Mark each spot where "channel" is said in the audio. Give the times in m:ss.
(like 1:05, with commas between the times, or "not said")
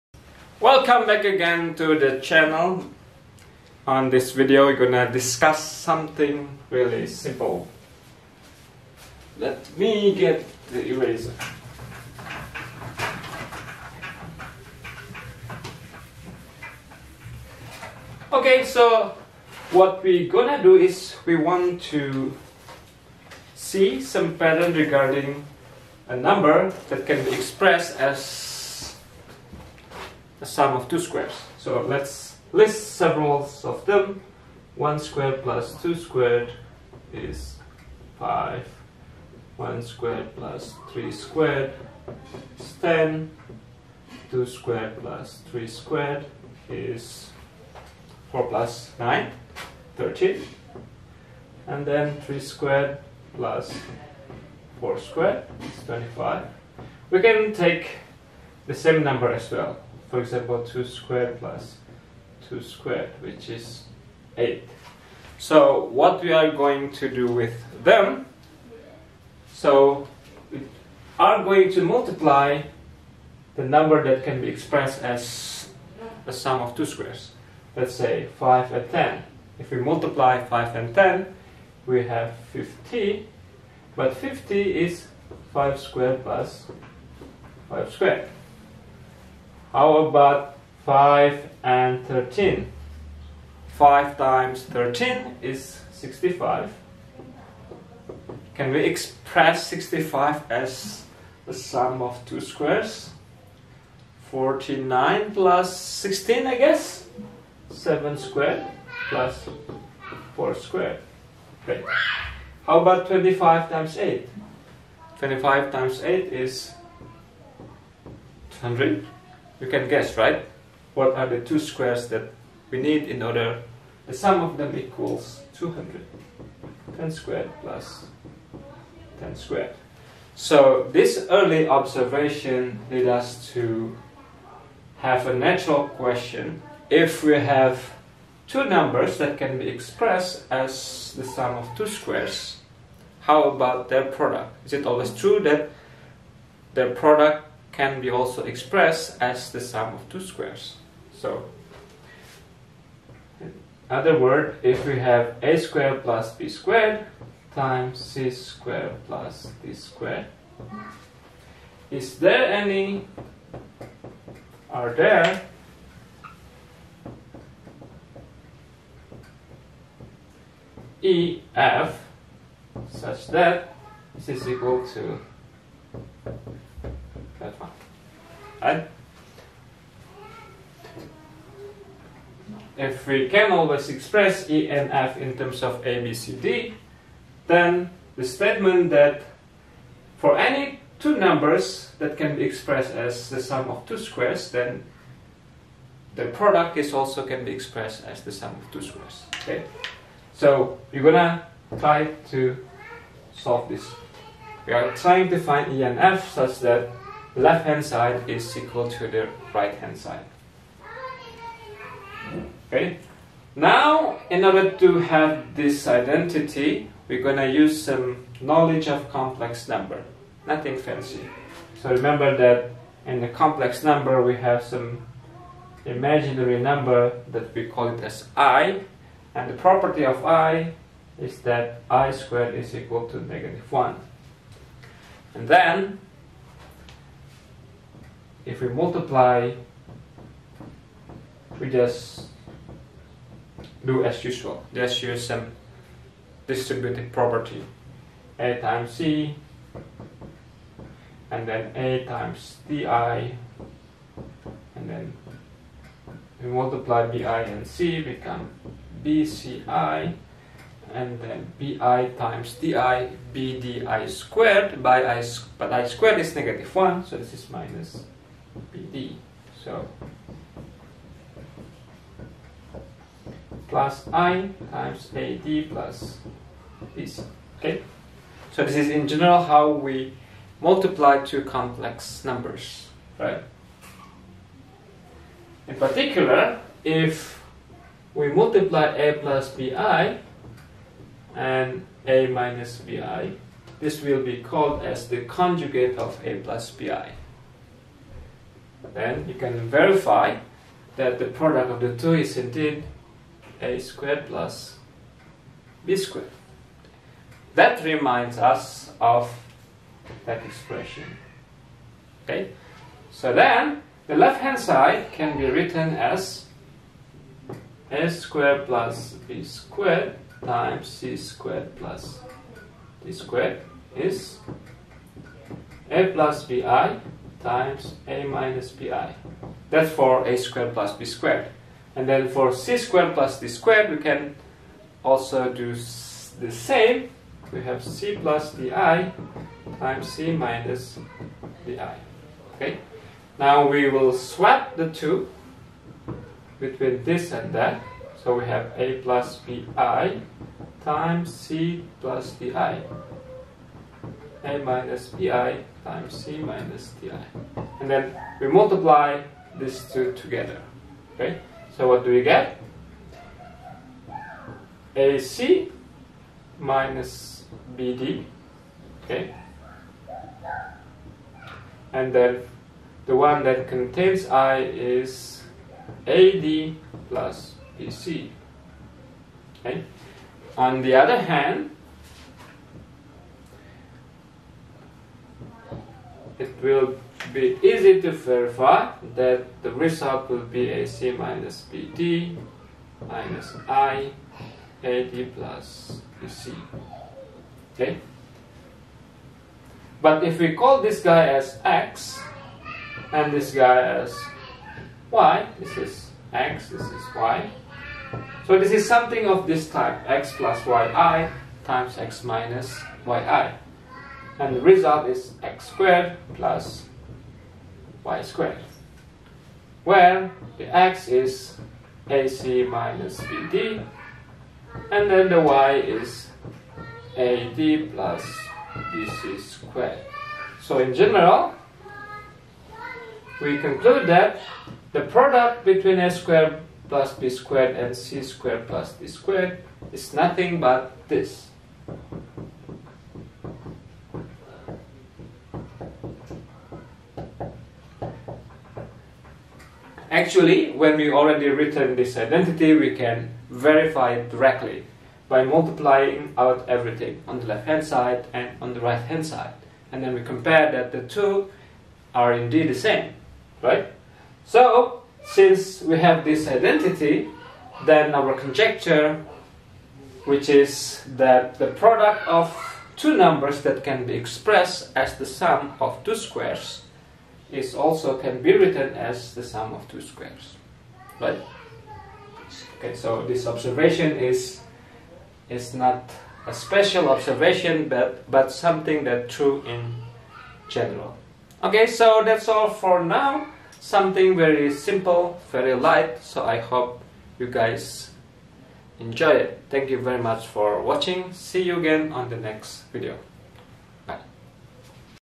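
0:02.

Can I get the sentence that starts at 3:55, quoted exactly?
And then if we multiply, we just do as usual, just use some distributive property.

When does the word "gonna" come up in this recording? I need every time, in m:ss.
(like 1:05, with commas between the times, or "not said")
0:04, 0:20, 3:21.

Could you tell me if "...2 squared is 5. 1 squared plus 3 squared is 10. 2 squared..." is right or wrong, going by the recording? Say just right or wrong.
right.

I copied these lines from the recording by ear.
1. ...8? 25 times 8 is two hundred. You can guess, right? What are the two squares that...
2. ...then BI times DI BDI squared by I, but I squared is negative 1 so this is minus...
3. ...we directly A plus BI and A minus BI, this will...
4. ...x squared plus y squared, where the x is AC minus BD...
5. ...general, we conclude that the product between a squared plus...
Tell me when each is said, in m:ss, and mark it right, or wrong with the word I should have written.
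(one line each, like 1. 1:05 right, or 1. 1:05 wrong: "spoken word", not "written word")
1. 1:53 right
2. 4:21 right
3. 4:48 wrong: "multiply", not "directly"
4. 6:55 right
5. 7:10 right.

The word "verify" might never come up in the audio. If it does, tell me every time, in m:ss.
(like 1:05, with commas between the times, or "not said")
4:59, 6:28, 7:33.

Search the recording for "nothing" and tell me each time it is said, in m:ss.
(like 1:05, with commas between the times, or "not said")
3:40, 7:20.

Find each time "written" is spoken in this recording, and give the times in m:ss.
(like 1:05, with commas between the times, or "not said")
5:15, 7:31, 7:58.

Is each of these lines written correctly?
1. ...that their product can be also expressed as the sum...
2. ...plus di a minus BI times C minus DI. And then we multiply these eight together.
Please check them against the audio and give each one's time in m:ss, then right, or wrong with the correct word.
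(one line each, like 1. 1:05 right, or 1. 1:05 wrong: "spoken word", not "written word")
1. 2:25 right
2. 5:52 wrong: "two", not "eight".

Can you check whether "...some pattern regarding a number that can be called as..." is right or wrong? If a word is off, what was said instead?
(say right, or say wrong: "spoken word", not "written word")
wrong: "expressed", not "called".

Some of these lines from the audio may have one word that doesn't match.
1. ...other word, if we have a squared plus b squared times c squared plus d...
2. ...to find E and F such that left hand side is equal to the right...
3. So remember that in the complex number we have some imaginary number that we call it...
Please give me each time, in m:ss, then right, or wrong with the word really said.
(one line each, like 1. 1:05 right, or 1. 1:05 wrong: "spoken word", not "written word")
1. 2:33 right
2. 3:25 right
3. 3:41 right.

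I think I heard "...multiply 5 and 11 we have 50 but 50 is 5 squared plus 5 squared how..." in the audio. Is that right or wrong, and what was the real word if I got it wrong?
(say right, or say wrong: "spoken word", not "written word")
wrong: "10", not "11".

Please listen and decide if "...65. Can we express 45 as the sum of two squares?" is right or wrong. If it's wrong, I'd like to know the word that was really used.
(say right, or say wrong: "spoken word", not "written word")
wrong: "65", not "45".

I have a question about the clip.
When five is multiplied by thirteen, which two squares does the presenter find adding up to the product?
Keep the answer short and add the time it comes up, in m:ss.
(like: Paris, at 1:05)
7 squared plus 4 squared, at 1:47.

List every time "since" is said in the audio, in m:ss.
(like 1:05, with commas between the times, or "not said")
7:45.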